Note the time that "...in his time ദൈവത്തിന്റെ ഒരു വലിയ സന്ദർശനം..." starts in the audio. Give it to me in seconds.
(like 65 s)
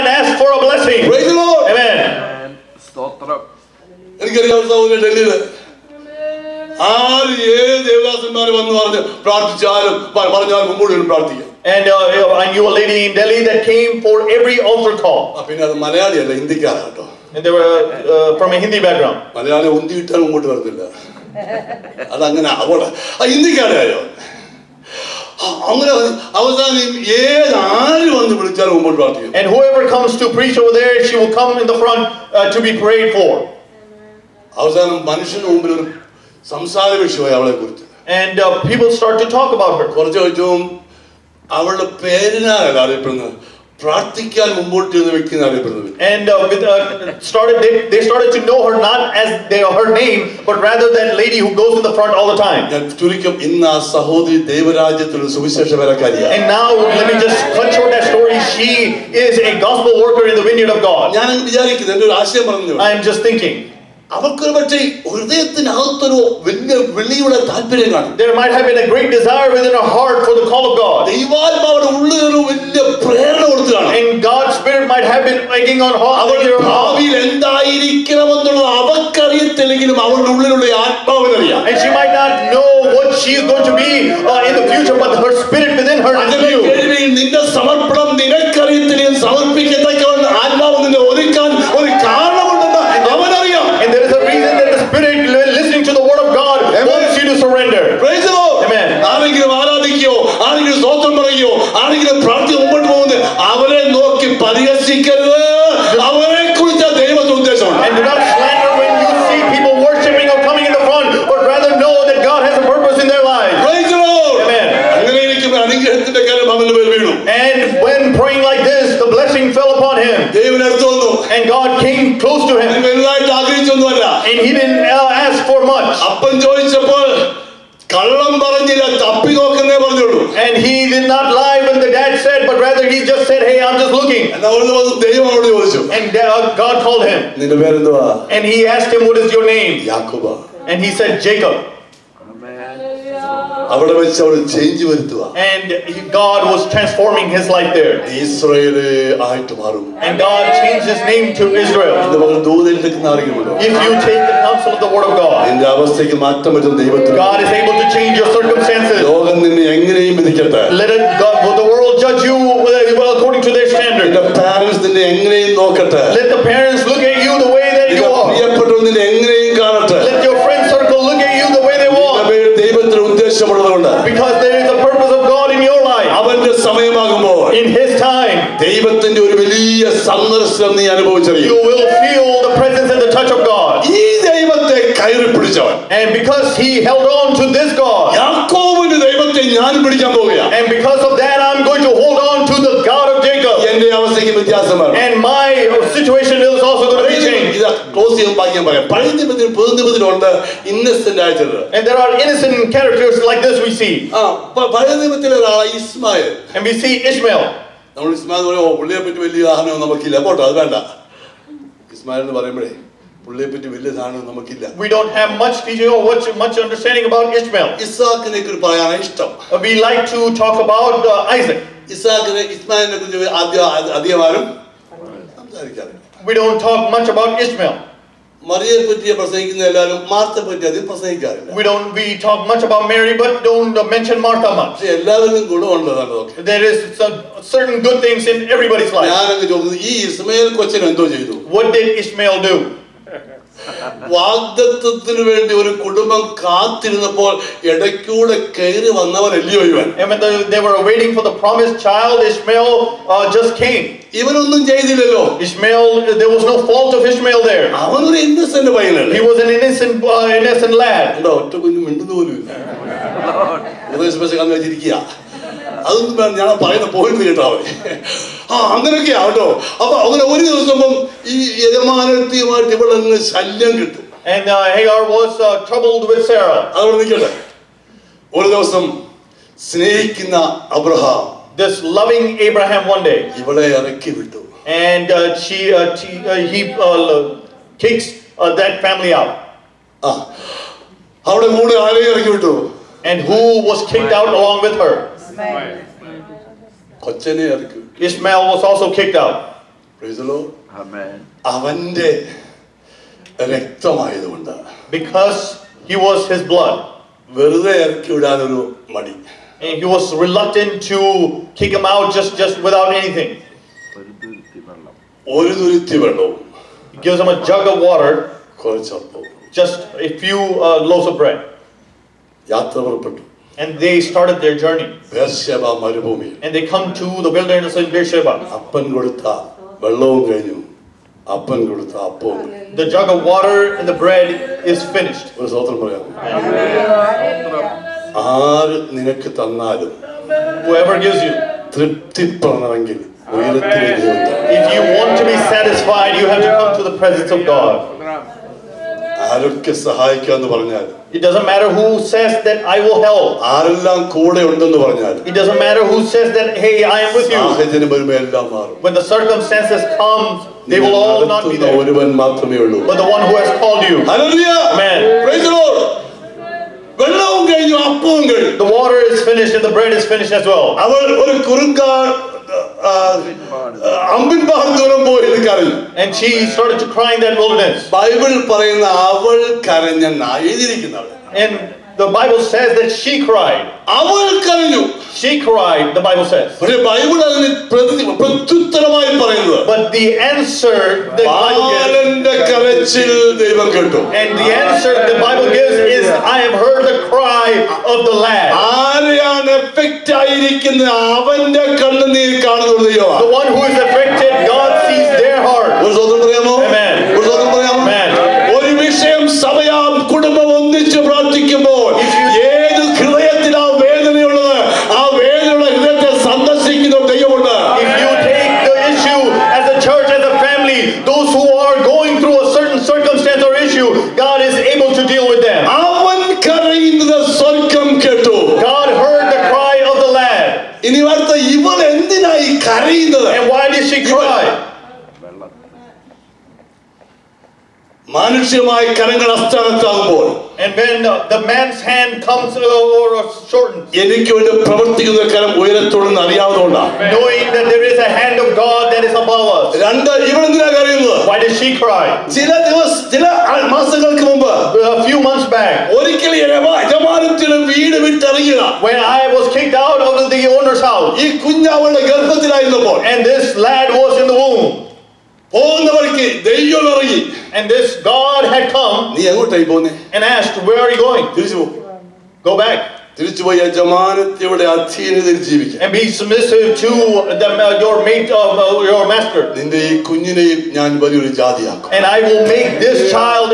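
177 s.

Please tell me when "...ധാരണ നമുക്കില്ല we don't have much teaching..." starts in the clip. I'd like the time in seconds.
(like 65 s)
213 s.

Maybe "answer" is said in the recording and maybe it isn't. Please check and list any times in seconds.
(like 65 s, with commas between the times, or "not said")
390 s, 394 s.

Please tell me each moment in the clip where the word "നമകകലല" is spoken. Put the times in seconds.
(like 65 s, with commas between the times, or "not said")
209 s, 214 s.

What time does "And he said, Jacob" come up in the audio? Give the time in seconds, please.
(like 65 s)
140 s.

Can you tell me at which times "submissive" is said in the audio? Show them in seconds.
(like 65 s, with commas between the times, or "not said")
476 s.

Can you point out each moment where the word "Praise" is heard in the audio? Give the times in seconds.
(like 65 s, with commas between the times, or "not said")
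1 s, 299 s, 365 s.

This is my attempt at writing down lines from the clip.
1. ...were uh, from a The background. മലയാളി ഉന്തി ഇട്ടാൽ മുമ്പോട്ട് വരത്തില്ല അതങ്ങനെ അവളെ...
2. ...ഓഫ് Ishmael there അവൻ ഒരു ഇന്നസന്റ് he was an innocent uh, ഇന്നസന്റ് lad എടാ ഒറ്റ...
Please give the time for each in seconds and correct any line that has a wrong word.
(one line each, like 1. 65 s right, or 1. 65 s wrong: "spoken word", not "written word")
1. 17 s wrong: "Hindi", not "The"
2. 256 s right.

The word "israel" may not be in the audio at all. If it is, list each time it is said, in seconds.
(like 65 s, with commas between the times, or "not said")
151 s.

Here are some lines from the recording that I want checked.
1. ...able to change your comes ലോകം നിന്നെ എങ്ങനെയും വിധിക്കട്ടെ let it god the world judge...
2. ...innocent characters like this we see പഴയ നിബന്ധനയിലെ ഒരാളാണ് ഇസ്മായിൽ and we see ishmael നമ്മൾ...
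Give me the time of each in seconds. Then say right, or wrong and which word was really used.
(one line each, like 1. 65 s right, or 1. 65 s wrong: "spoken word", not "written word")
1. 157 s wrong: "circumstances", not "comes"
2. 202 s right.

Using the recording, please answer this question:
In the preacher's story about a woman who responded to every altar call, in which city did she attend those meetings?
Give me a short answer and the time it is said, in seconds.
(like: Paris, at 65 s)
Delhi, at 13 s.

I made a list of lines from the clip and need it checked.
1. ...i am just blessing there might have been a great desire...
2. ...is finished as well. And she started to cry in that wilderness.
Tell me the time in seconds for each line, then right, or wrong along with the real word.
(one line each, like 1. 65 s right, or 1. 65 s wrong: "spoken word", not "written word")
1. 61 s wrong: "thinking", not "blessing"
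2. 369 s right.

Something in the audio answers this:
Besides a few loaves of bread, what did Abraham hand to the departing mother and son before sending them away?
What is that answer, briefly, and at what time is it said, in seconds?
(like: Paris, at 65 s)
a jug of water, at 317 s.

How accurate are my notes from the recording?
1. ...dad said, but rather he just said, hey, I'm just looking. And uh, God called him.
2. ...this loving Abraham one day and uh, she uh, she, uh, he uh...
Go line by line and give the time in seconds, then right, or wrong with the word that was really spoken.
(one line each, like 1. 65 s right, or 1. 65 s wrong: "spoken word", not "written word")
1. 131 s right
2. 281 s right.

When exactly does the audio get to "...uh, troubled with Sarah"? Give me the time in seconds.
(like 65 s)
275 s.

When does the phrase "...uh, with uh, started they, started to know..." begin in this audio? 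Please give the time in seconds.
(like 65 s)
43 s.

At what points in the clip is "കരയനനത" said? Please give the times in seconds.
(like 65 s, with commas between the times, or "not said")
432 s.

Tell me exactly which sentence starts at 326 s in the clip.
And they come to the wilderness in Beersheba.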